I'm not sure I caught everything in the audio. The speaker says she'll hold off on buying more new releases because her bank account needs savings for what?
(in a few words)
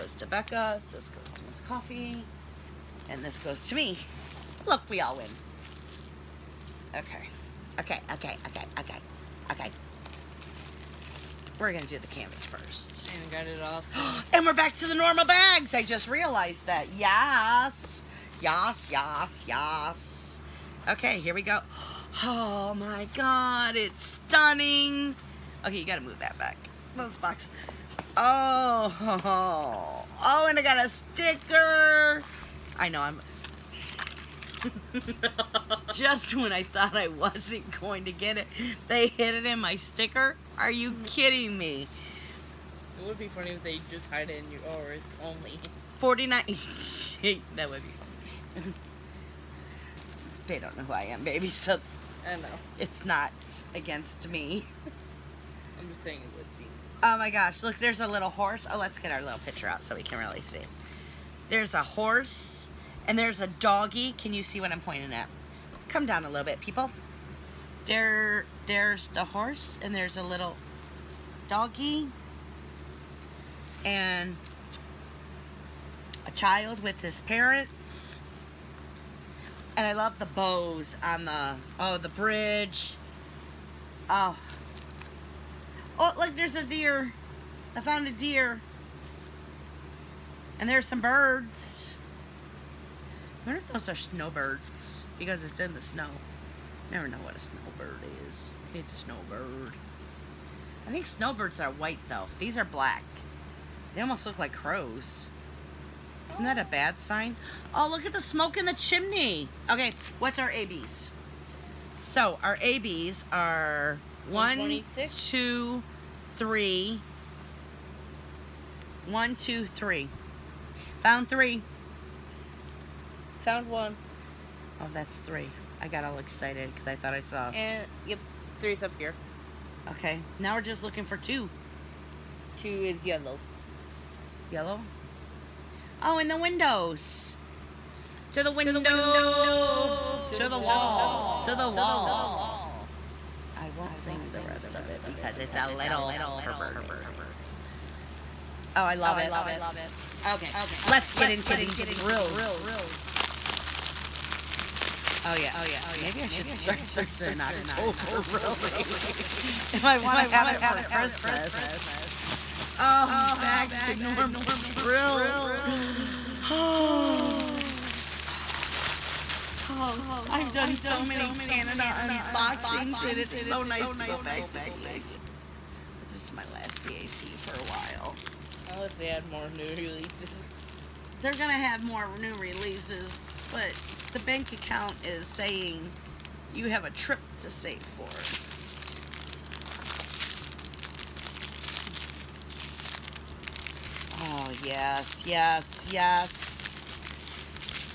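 A trip.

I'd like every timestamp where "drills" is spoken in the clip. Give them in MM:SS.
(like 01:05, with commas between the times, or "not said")
02:31, 02:44.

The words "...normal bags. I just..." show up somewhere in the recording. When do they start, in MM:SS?
00:14.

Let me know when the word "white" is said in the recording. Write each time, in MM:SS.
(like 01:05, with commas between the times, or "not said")
01:41.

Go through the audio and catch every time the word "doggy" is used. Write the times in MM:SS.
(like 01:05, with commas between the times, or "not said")
01:03, 01:11.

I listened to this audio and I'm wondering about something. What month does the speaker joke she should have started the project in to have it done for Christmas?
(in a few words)
October.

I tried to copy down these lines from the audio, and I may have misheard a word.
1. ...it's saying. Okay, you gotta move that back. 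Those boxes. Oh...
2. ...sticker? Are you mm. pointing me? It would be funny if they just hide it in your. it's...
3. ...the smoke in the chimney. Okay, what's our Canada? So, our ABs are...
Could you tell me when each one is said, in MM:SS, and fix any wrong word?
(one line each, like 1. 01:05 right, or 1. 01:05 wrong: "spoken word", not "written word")
1. 00:23 wrong: "stunning", not "saying"
2. 00:39 wrong: "kidding", not "pointing"
3. 01:48 wrong: "ABs", not "Canada".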